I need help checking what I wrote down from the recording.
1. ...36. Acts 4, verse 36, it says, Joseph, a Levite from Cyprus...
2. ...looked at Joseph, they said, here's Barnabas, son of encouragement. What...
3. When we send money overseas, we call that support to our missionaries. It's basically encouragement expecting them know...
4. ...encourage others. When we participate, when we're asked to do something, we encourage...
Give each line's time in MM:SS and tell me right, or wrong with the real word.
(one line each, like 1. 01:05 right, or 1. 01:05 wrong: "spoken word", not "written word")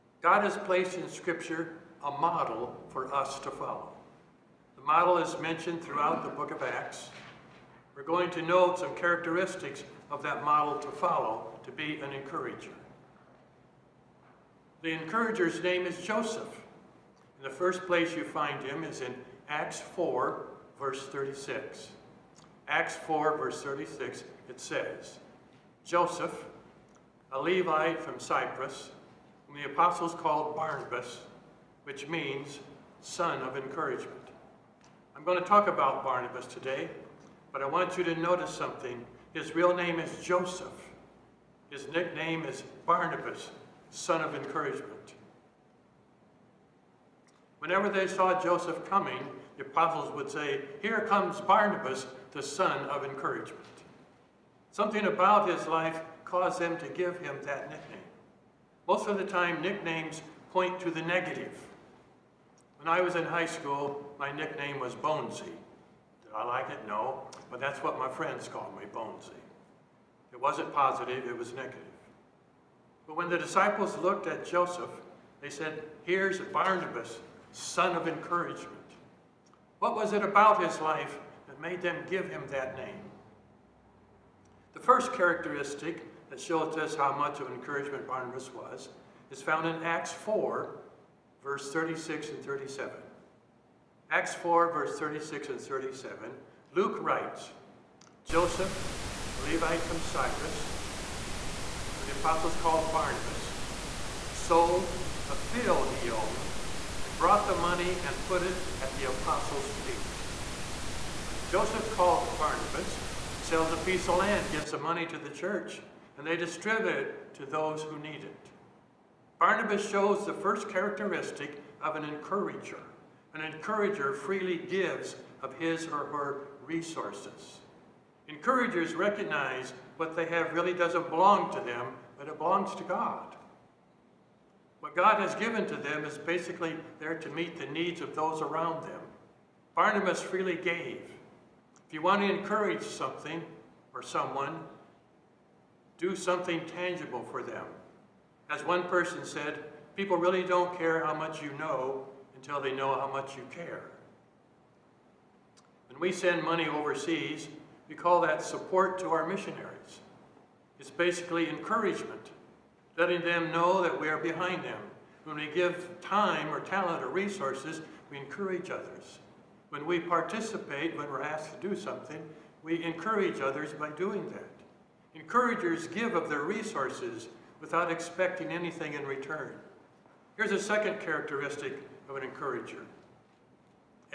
1. 00:21 right
2. 01:13 right
3. 02:35 wrong: "letting", not "expecting"
4. 02:48 right.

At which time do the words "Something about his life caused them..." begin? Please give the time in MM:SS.
00:54.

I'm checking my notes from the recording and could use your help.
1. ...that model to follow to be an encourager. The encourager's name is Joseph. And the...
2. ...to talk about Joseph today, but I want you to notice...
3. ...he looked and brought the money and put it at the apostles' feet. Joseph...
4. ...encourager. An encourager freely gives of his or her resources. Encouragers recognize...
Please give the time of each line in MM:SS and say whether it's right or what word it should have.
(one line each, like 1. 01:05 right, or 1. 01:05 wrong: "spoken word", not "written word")
1. 00:10 right
2. 00:35 wrong: "Barnabas", not "Joseph"
3. 01:45 wrong: "owned", not "looked"
4. 02:02 right.